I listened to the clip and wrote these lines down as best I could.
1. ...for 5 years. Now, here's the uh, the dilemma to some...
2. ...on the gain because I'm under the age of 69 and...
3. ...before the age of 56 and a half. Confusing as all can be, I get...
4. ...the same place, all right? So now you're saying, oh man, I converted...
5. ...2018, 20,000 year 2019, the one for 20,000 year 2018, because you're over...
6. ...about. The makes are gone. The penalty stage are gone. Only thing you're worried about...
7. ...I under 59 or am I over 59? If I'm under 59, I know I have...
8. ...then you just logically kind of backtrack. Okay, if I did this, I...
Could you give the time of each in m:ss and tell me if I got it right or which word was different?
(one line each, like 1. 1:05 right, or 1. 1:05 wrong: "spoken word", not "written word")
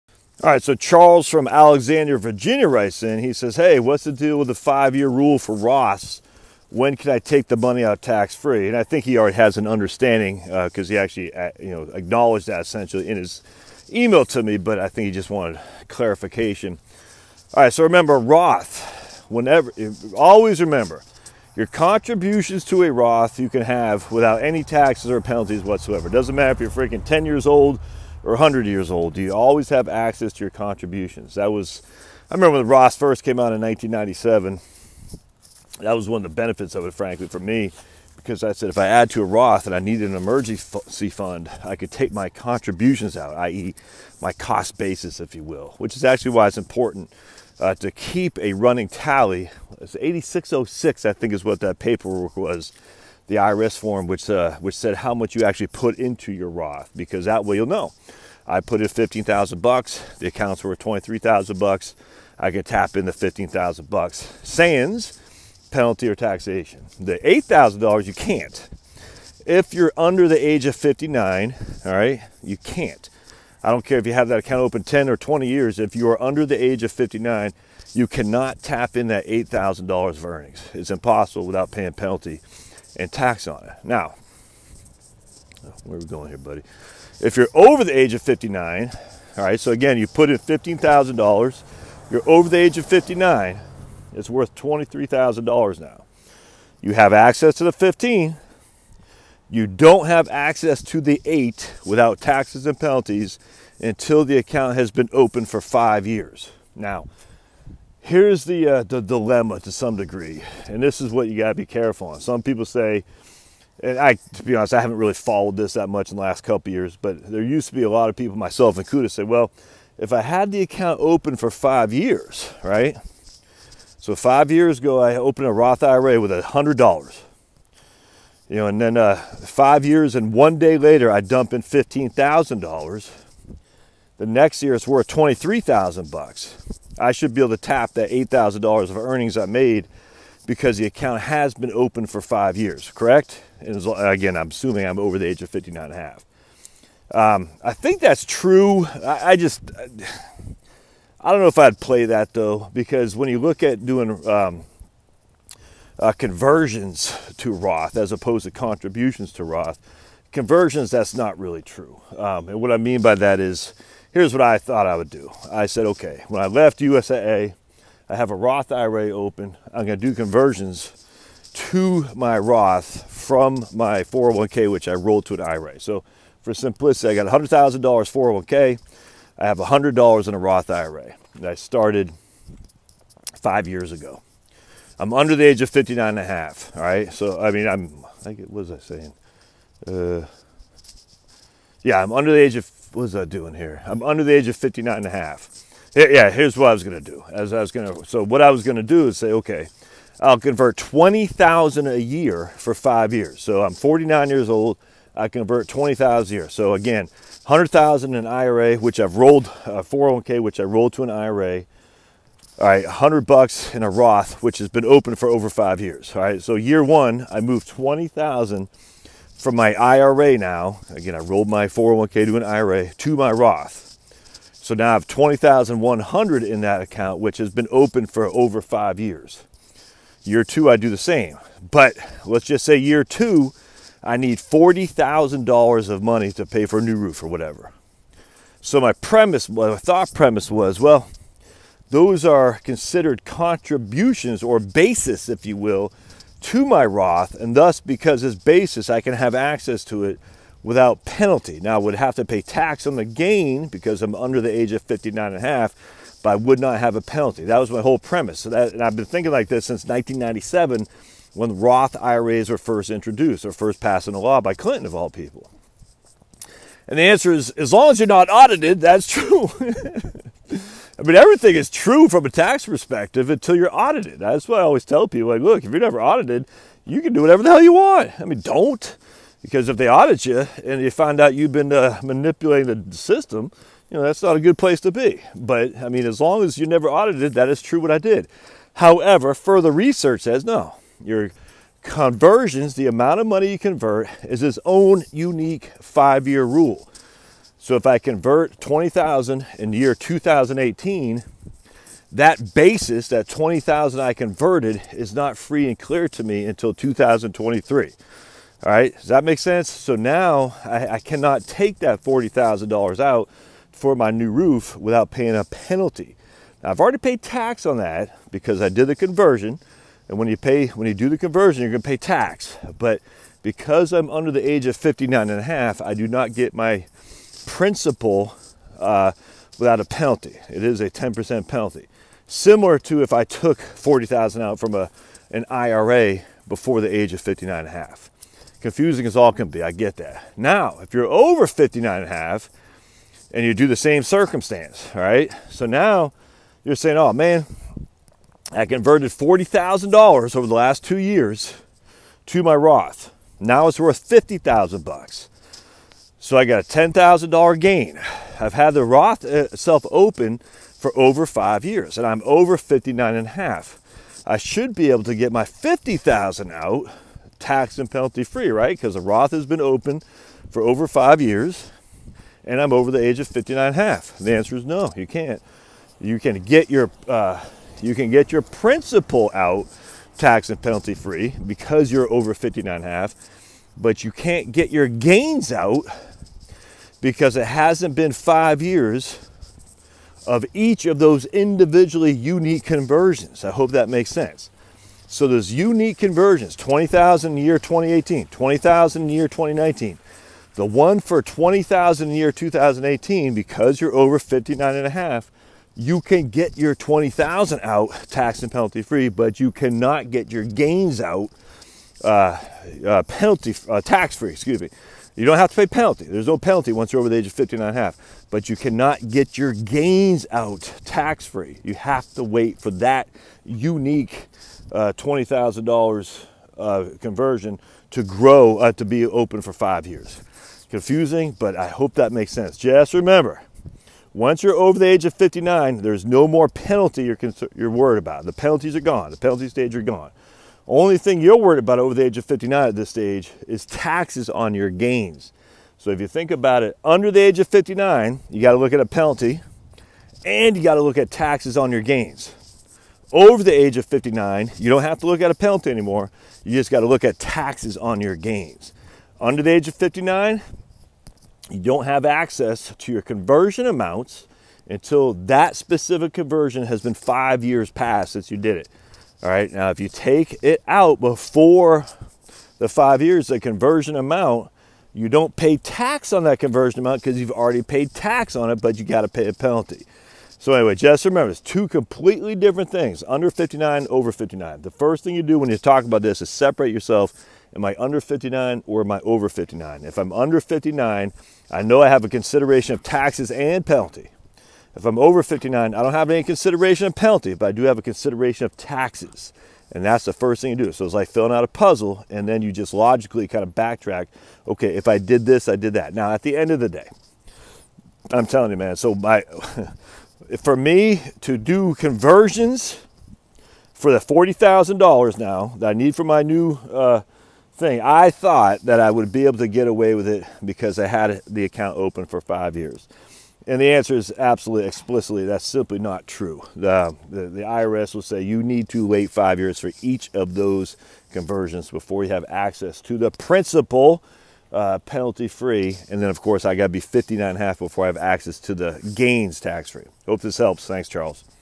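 1. 1:45 right
2. 4:12 wrong: "59", not "69"
3. 5:36 wrong: "59", not "56"
4. 5:43 wrong: "circumstance", not "place"
5. 6:37 right
6. 7:17 wrong: "penalties", not "makes"
7. 8:07 right
8. 8:22 right.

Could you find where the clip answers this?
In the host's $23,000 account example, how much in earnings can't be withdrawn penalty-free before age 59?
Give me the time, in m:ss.
1:07.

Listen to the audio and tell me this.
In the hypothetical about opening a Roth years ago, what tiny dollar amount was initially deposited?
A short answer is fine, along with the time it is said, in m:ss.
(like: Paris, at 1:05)
$100, at 2:06.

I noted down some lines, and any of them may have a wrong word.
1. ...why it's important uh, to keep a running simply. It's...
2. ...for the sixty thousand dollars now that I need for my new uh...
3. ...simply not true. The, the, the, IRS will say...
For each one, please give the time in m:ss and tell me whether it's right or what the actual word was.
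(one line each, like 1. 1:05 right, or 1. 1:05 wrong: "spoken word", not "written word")
1. 0:46 wrong: "tally", not "simply"
2. 8:33 wrong: "forty", not "sixty"
3. 8:45 right.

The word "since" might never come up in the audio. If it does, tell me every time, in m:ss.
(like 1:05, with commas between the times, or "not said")
4:19, 7:48.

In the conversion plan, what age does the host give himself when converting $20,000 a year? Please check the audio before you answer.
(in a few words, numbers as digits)
49.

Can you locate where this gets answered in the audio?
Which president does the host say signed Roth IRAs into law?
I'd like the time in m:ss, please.
4:24.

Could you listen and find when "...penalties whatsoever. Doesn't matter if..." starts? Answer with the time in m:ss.
0:25.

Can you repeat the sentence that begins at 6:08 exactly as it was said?
Because the Roth has been open for over five years and I'm over the age of 59 and a half.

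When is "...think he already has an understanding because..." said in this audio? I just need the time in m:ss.
0:08.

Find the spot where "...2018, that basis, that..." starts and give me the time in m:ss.
4:59.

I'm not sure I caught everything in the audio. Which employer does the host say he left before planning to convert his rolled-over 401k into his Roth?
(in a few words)
USAA.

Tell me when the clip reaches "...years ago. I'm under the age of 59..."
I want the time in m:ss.
3:03.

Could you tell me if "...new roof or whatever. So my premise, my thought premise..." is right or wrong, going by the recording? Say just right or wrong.
right.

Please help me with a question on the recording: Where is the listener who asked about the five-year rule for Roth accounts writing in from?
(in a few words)
Alexandria, Virginia.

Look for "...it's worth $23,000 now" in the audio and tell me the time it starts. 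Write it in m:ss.
1:34.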